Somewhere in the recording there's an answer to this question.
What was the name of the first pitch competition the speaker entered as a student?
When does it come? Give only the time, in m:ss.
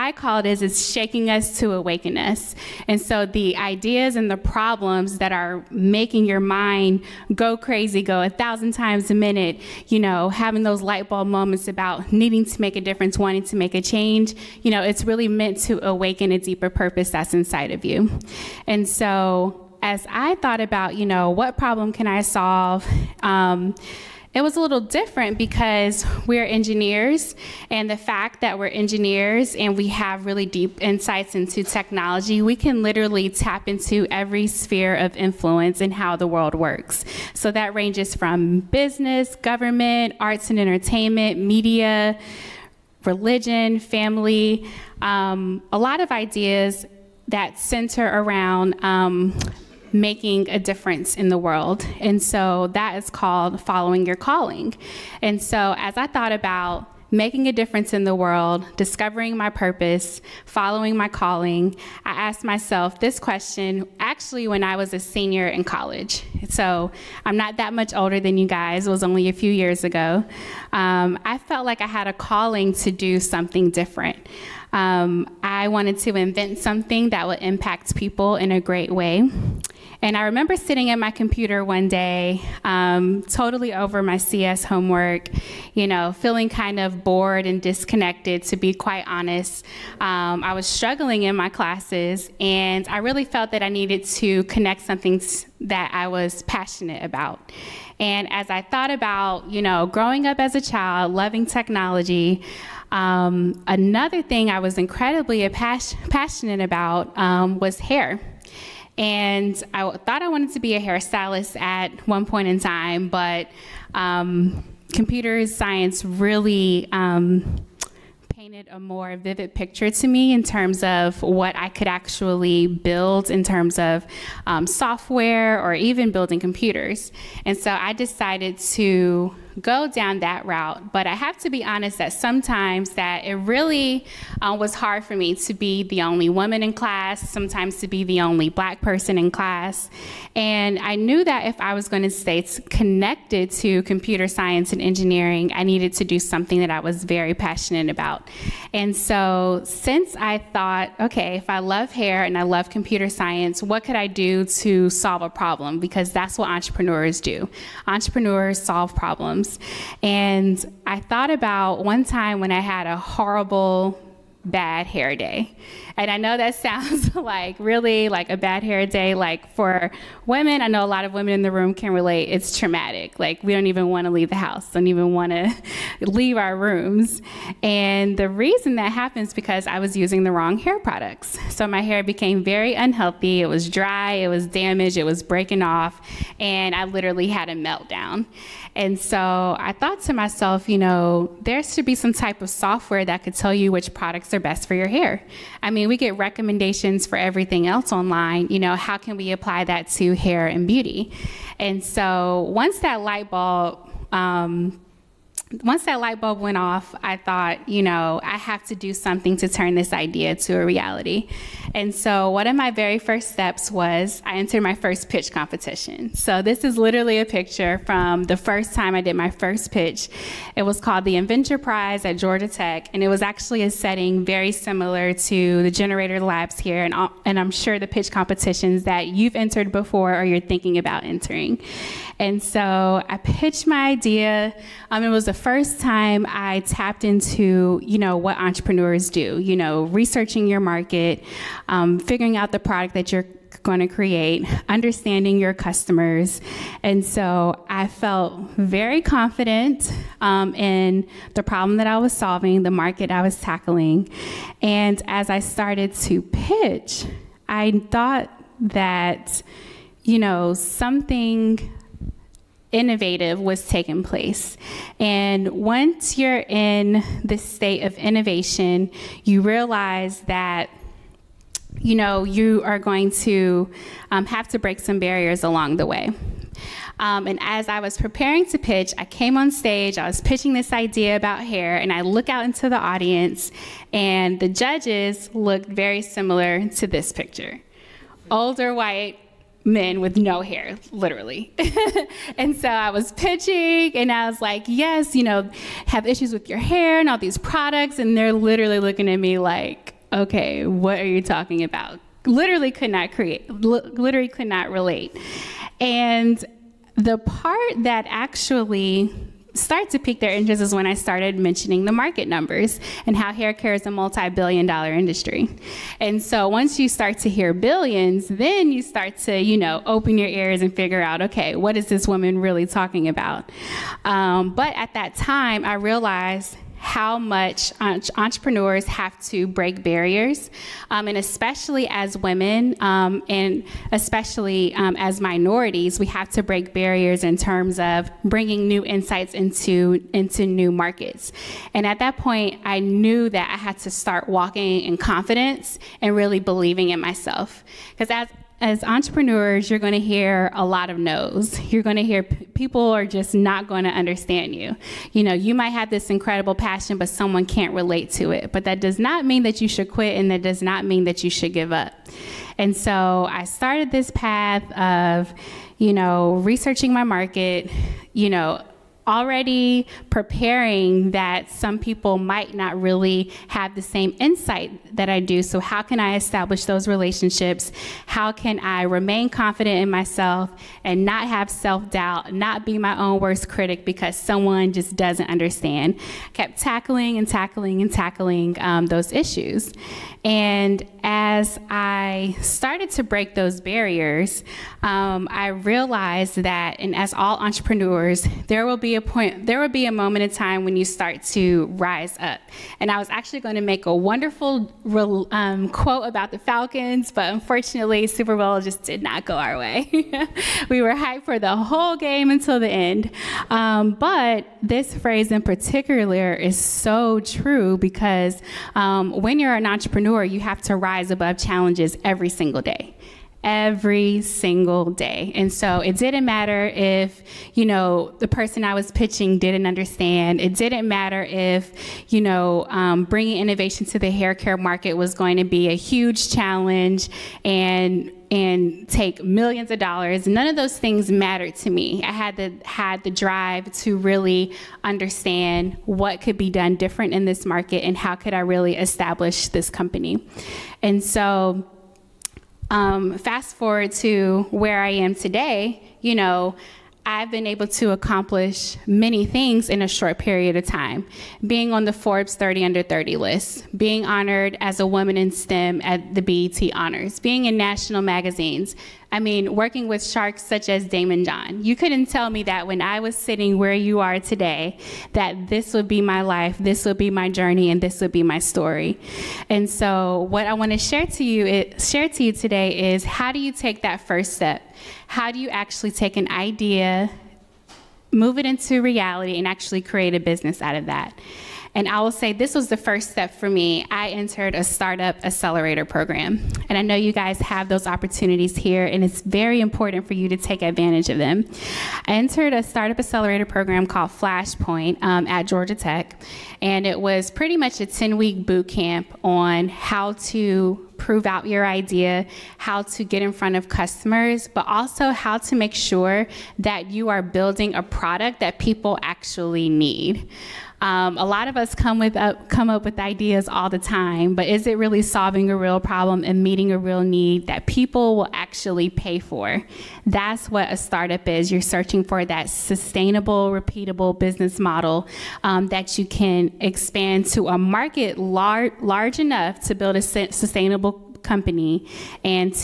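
3:41.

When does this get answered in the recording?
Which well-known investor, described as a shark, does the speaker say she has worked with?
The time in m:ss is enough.
7:50.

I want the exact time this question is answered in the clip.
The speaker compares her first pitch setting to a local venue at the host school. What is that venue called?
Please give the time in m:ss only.
3:45.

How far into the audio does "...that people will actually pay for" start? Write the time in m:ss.
8:47.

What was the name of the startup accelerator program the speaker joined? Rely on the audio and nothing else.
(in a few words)
Flashpoint.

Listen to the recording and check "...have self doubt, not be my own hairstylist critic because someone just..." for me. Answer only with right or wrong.
wrong.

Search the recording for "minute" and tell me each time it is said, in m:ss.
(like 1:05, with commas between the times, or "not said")
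0:09.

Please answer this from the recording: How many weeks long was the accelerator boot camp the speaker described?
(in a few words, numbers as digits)
10.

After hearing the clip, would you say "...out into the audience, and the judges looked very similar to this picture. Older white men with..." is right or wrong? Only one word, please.
right.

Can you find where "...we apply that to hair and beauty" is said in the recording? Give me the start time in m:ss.
3:19.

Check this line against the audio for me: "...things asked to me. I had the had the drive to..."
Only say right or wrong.
wrong.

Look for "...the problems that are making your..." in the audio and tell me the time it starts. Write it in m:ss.
0:04.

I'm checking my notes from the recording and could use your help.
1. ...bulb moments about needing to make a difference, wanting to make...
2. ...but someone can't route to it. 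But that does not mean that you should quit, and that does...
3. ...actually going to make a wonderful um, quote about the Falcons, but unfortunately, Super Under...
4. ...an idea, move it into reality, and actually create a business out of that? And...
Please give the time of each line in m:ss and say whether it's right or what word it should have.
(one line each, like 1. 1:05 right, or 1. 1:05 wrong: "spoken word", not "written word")
1. 0:11 right
2. 5:56 wrong: "relate", not "route"
3. 6:43 wrong: "Bowl", not "Under"
4. 8:06 right.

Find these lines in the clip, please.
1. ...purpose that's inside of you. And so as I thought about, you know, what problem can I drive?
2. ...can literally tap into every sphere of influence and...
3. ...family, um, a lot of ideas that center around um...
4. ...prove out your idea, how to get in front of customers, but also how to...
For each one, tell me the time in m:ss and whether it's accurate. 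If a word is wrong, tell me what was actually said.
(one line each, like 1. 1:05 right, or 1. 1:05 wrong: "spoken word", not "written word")
1. 0:16 wrong: "solve", not "drive"
2. 0:32 right
3. 0:43 right
4. 8:30 right.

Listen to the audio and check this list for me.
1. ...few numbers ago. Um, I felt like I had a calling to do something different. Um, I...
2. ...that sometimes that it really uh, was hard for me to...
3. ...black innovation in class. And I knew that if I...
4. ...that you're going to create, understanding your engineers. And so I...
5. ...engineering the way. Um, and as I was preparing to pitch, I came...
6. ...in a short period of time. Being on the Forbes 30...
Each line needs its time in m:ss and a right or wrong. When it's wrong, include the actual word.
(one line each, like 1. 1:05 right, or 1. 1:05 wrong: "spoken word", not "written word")
1. 1:09 wrong: "years", not "numbers"
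2. 2:11 right
3. 2:18 wrong: "person", not "innovation"
4. 4:02 wrong: "customers", not "engineers"
5. 4:35 wrong: "along", not "engineering"
6. 7:39 right.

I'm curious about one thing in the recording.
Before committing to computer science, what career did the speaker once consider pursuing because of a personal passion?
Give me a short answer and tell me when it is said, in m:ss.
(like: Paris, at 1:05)
hairstylist, at 1:50.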